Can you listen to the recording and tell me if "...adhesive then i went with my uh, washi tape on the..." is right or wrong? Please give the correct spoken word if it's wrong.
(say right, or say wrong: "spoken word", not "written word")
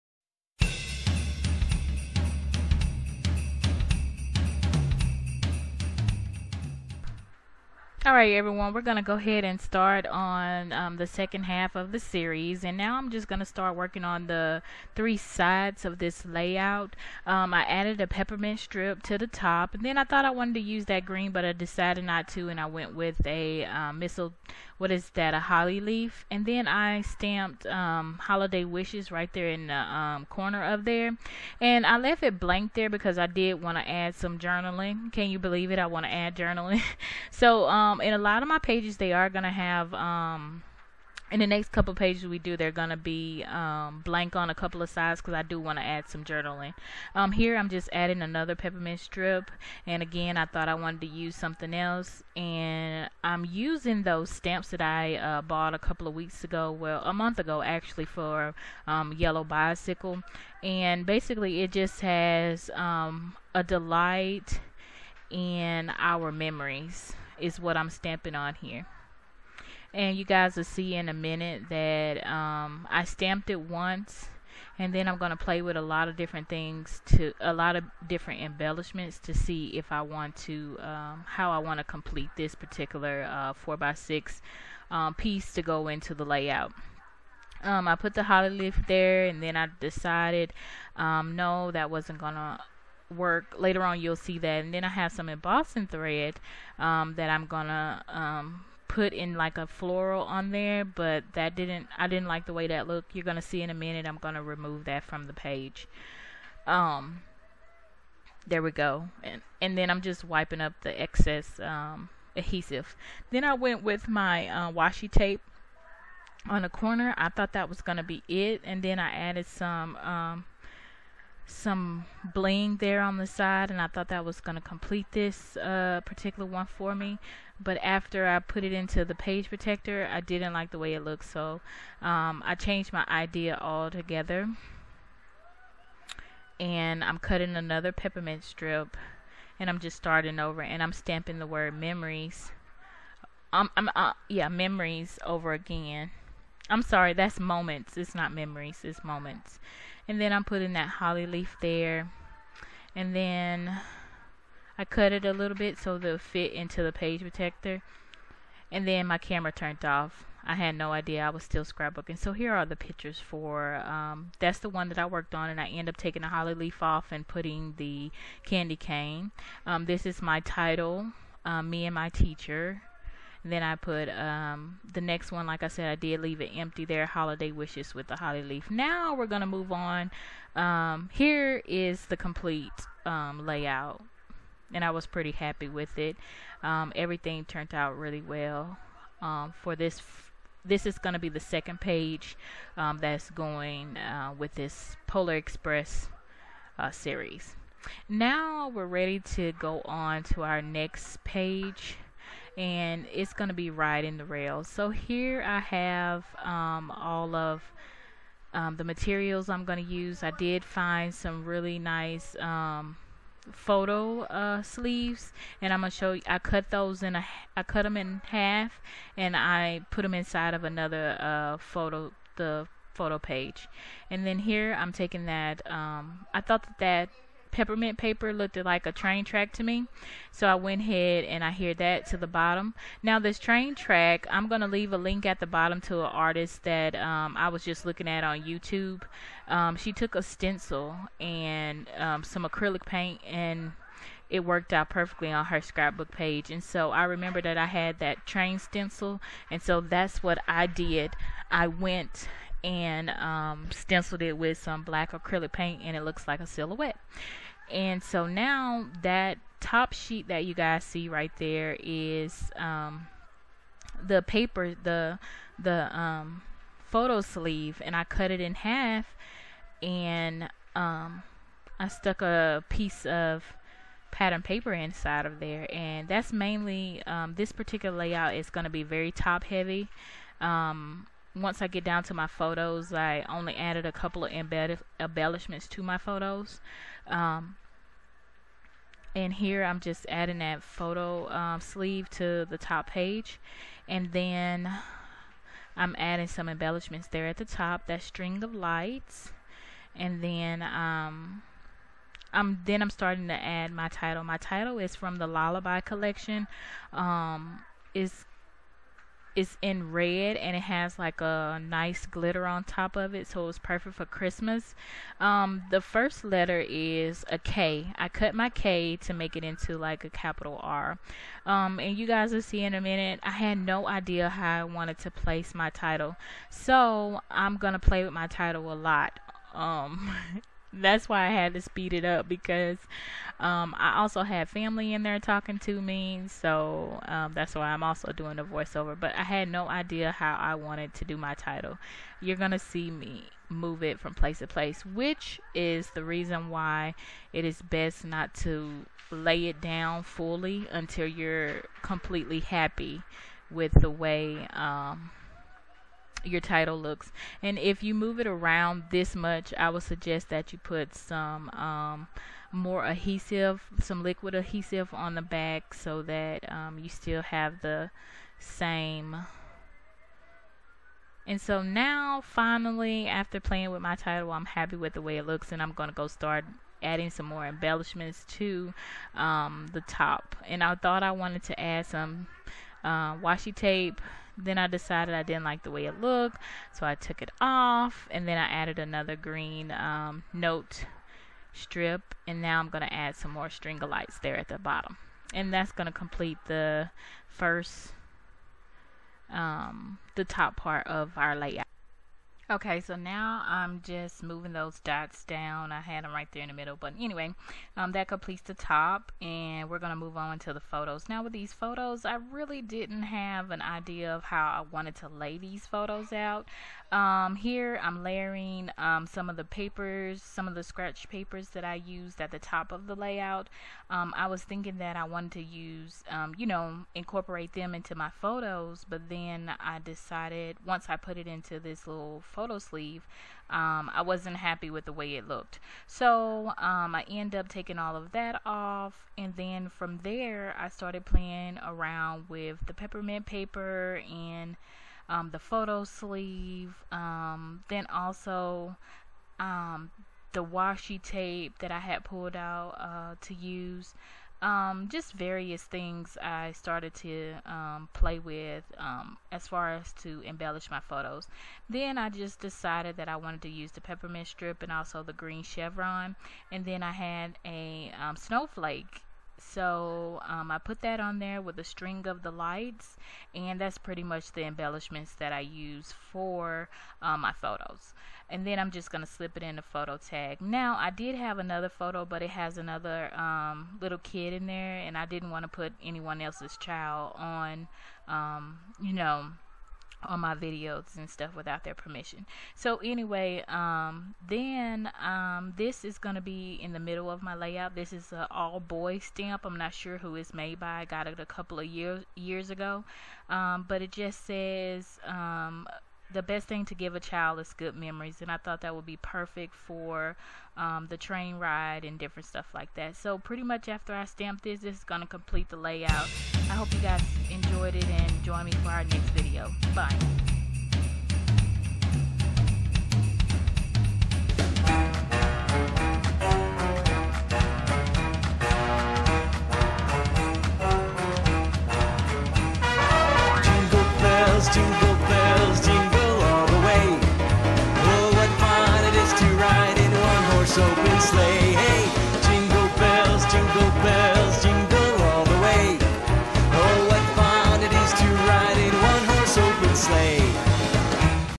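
right.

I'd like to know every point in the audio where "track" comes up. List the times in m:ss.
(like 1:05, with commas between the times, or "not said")
3:49, 3:53.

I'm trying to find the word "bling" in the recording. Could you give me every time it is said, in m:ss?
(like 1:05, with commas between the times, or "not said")
2:02.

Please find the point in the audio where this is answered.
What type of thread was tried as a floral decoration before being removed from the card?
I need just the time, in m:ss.
1:35.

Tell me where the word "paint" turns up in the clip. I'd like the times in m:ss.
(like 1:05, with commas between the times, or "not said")
4:02, 4:15.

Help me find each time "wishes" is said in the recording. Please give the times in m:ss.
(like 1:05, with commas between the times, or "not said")
0:28, 2:57.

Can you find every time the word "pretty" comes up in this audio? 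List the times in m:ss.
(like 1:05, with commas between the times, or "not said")
3:05, 7:53, 8:33.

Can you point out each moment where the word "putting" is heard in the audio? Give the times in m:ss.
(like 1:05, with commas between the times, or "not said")
2:30, 2:47.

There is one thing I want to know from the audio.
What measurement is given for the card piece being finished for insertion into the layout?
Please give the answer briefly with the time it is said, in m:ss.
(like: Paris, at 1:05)
4x6, at 1:23.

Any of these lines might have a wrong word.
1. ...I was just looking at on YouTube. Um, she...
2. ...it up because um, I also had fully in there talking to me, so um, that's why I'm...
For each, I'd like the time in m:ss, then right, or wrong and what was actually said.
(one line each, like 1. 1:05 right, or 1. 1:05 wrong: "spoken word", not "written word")
1. 3:57 right
2. 5:31 wrong: "family", not "fully".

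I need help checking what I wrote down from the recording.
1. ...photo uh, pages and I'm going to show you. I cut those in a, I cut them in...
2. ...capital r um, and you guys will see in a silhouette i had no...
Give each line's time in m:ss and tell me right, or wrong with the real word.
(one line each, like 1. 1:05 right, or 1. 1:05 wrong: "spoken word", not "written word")
1. 3:33 wrong: "sleeves", not "pages"
2. 5:20 wrong: "minute", not "silhouette".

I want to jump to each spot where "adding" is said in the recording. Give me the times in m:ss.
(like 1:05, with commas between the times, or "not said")
0:47, 4:50, 4:55, 6:16.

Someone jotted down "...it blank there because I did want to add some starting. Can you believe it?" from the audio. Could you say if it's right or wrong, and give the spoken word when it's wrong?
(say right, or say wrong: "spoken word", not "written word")
wrong: "journaling", not "starting".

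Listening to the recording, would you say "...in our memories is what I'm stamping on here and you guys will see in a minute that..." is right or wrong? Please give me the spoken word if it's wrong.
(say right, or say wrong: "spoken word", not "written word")
right.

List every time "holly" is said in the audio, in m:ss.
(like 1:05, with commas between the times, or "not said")
0:25, 1:28, 2:30, 2:46, 2:58.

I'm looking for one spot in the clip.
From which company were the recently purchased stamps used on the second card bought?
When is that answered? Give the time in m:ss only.
0:59.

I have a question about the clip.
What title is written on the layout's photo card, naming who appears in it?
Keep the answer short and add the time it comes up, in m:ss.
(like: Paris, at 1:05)
Me and my teacher, at 2:51.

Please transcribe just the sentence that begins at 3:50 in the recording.
So I went ahead and I hear that to the bottom.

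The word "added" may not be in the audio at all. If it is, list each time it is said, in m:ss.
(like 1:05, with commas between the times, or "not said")
0:17, 1:59, 4:43, 6:28.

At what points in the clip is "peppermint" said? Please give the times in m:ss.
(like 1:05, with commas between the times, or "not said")
0:18, 0:48, 2:17, 3:47, 7:22, 7:43.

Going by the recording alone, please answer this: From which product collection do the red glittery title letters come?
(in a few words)
Lullaby.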